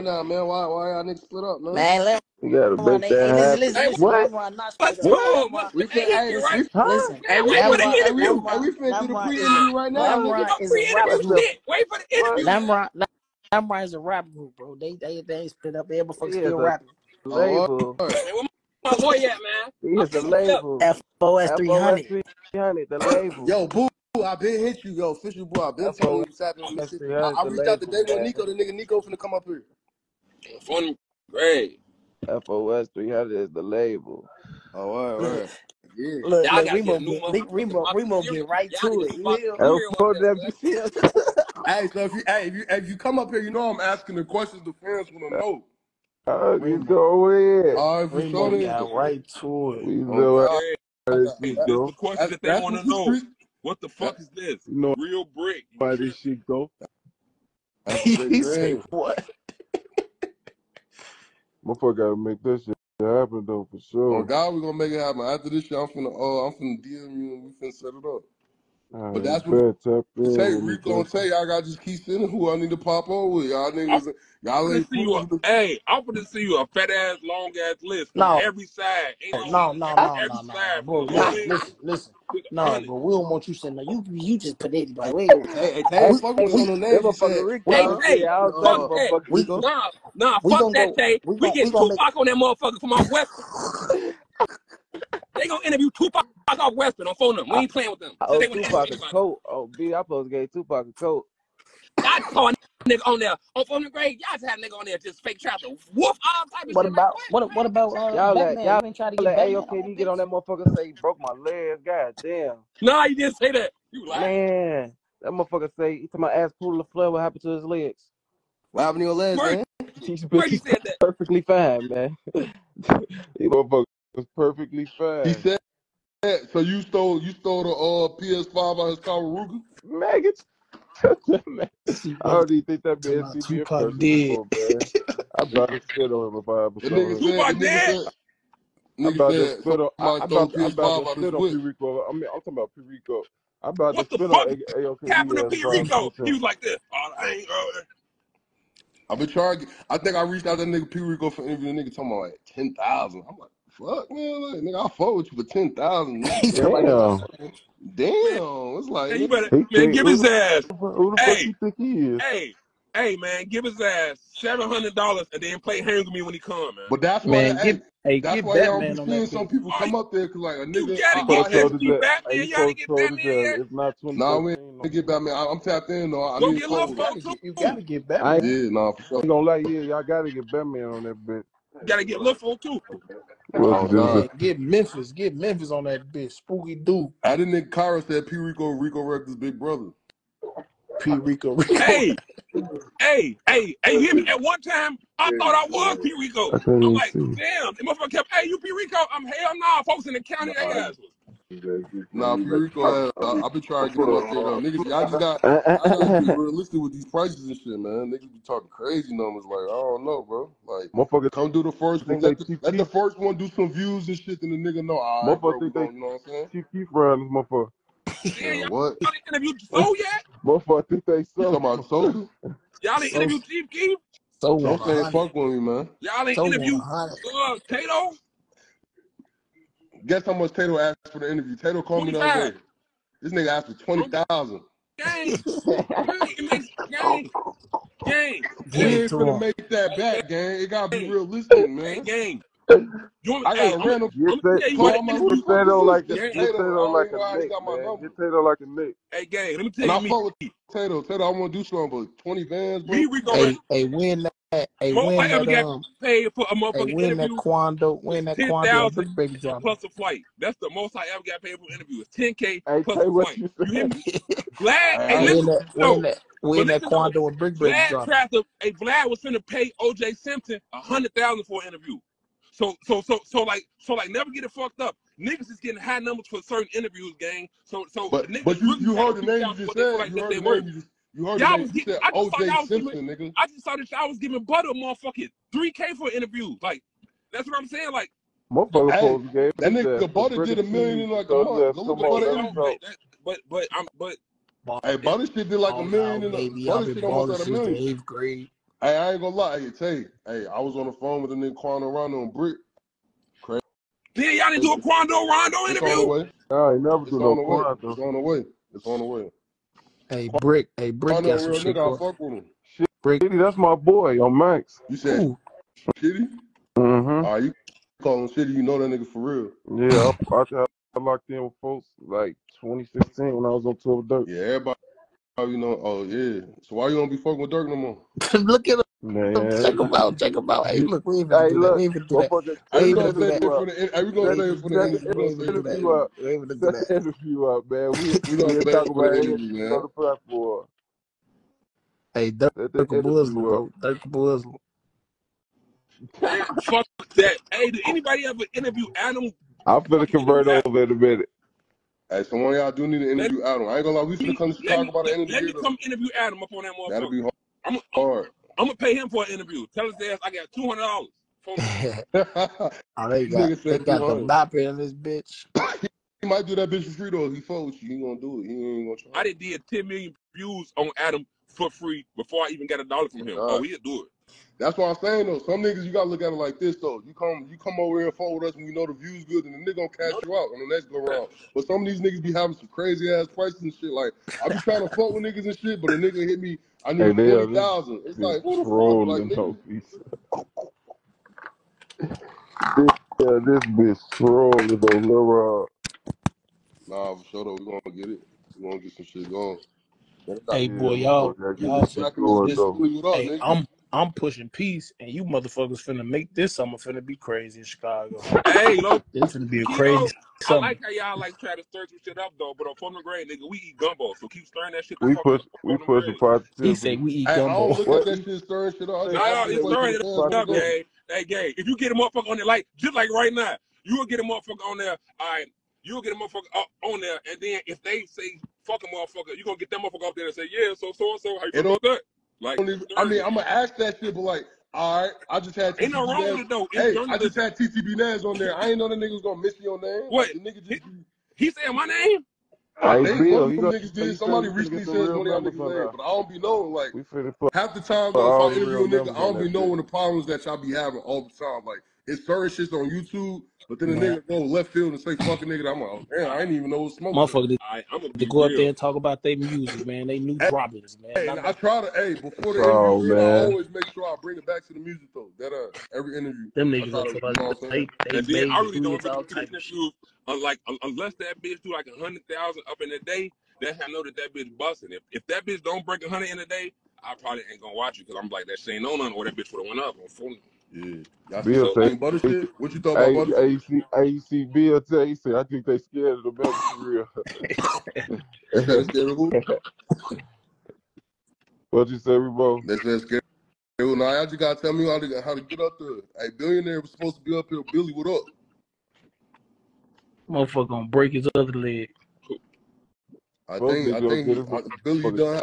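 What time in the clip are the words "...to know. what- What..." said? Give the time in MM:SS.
00:52.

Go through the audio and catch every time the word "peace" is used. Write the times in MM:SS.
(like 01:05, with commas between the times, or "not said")
06:44.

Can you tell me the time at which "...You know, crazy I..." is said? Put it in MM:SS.
06:49.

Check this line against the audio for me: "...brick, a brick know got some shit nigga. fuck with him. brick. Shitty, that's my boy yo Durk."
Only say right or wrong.
wrong.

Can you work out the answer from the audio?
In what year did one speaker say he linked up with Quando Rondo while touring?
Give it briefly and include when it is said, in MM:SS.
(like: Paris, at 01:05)
2016, at 05:22.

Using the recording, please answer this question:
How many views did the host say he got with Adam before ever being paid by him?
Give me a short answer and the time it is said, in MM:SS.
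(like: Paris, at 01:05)
10 million, at 06:09.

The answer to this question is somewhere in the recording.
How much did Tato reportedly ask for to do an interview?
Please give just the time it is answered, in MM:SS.
03:53.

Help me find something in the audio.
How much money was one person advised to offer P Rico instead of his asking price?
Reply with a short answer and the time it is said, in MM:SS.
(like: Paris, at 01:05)
$700, at 02:44.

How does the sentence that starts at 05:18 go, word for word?
You know that nigga for real.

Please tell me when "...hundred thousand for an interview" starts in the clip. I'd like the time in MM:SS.
04:30.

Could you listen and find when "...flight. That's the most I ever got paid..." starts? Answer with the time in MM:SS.
04:19.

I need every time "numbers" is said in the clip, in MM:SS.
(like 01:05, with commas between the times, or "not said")
03:29, 04:35.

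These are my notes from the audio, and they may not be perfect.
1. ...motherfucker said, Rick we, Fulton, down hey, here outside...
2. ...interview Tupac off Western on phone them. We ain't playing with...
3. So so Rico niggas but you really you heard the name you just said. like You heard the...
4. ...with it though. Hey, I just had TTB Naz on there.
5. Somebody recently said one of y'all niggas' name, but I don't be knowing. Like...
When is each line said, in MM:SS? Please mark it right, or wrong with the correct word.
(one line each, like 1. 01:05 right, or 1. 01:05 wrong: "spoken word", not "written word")
1. 01:27 wrong: "Hey", not "Fulton"
2. 01:35 right
3. 04:37 wrong: "But", not "Rico"
4. 07:16 right
5. 07:24 right.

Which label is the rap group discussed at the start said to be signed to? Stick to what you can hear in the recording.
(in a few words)
FOS 300.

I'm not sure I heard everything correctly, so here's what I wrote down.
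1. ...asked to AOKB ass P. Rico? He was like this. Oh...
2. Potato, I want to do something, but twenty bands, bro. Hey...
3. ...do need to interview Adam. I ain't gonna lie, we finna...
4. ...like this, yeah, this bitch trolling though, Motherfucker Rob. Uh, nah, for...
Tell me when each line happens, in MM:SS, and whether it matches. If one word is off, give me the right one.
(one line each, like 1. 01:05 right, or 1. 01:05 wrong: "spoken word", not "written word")
1. 02:25 wrong: "happened", not "asked"
2. 04:11 right
3. 05:52 right
4. 06:29 wrong: "Lil", not "Motherfucker".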